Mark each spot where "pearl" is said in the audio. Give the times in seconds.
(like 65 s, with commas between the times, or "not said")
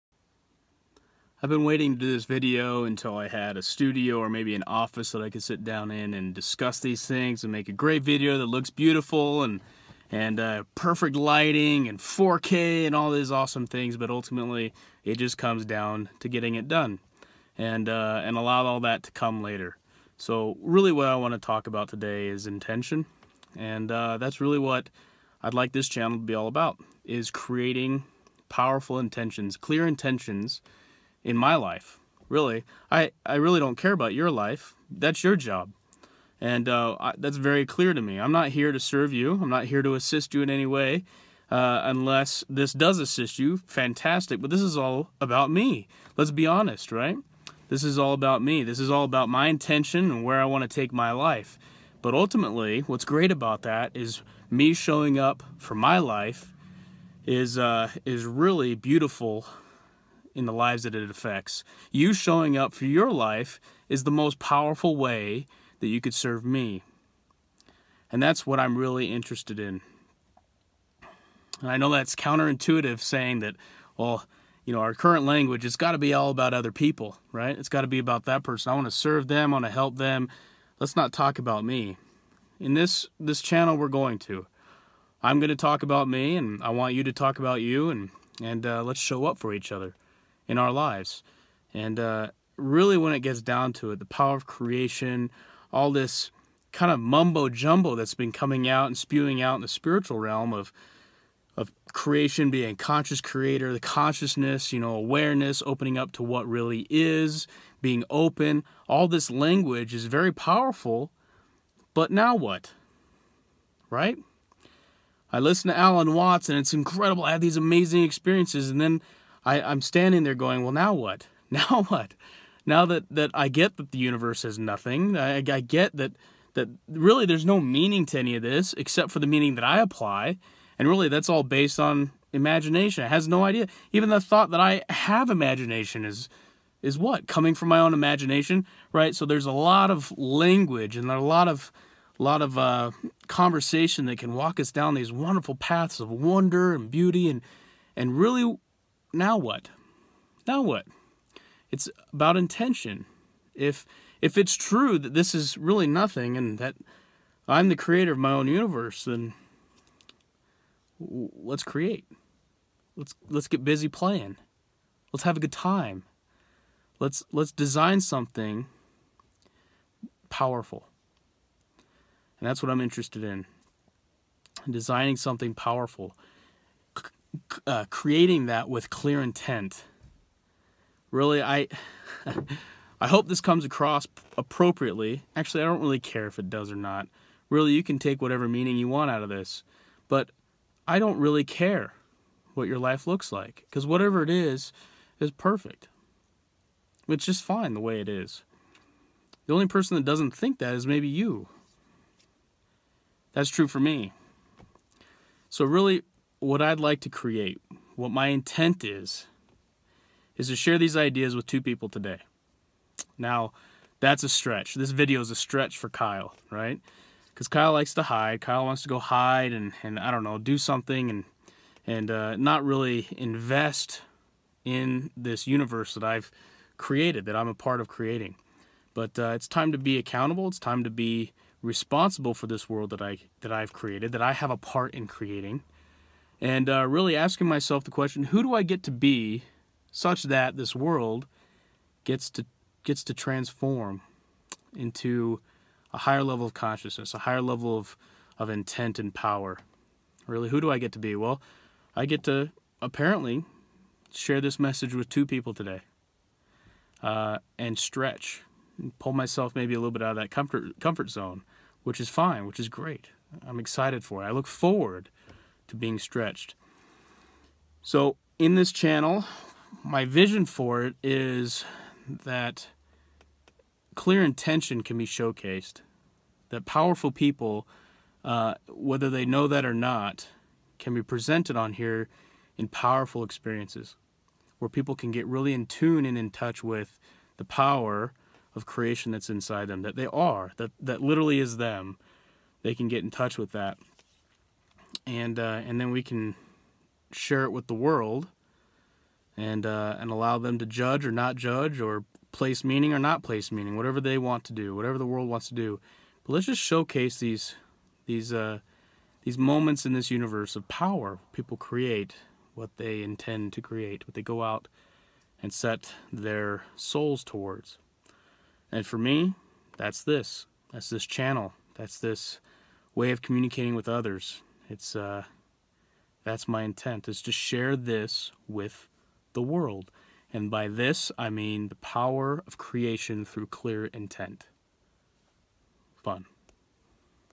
not said.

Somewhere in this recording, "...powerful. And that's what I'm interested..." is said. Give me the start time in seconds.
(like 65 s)
170 s.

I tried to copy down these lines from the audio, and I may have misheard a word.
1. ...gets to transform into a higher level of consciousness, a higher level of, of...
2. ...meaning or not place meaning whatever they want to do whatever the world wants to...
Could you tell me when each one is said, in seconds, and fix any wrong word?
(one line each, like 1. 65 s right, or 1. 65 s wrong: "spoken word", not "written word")
1. 242 s right
2. 302 s right.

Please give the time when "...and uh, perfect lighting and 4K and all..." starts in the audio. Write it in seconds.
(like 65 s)
10 s.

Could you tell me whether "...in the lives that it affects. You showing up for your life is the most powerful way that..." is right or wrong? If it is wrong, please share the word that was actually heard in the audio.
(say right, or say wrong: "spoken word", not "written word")
right.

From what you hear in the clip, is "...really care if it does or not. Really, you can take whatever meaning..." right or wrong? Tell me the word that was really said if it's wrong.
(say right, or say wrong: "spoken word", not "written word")
right.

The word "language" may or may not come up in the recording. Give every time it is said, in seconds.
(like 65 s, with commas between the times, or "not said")
75 s, 109 s, 140 s.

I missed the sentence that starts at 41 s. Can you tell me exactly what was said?
Uh, unless this does assist you, fantastic.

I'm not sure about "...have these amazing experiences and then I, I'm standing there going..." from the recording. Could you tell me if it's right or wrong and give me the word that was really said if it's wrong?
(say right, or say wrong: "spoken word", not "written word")
right.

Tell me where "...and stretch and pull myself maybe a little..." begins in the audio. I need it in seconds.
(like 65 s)
257 s.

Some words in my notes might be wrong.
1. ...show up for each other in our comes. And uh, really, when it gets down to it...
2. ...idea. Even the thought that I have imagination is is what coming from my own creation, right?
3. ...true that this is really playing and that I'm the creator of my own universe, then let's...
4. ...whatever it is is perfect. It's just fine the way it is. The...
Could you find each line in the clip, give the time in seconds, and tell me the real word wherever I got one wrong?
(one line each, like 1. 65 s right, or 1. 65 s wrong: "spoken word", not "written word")
1. 88 s wrong: "lives", not "comes"
2. 133 s wrong: "imagination", not "creation"
3. 154 s wrong: "nothing", not "playing"
4. 193 s right.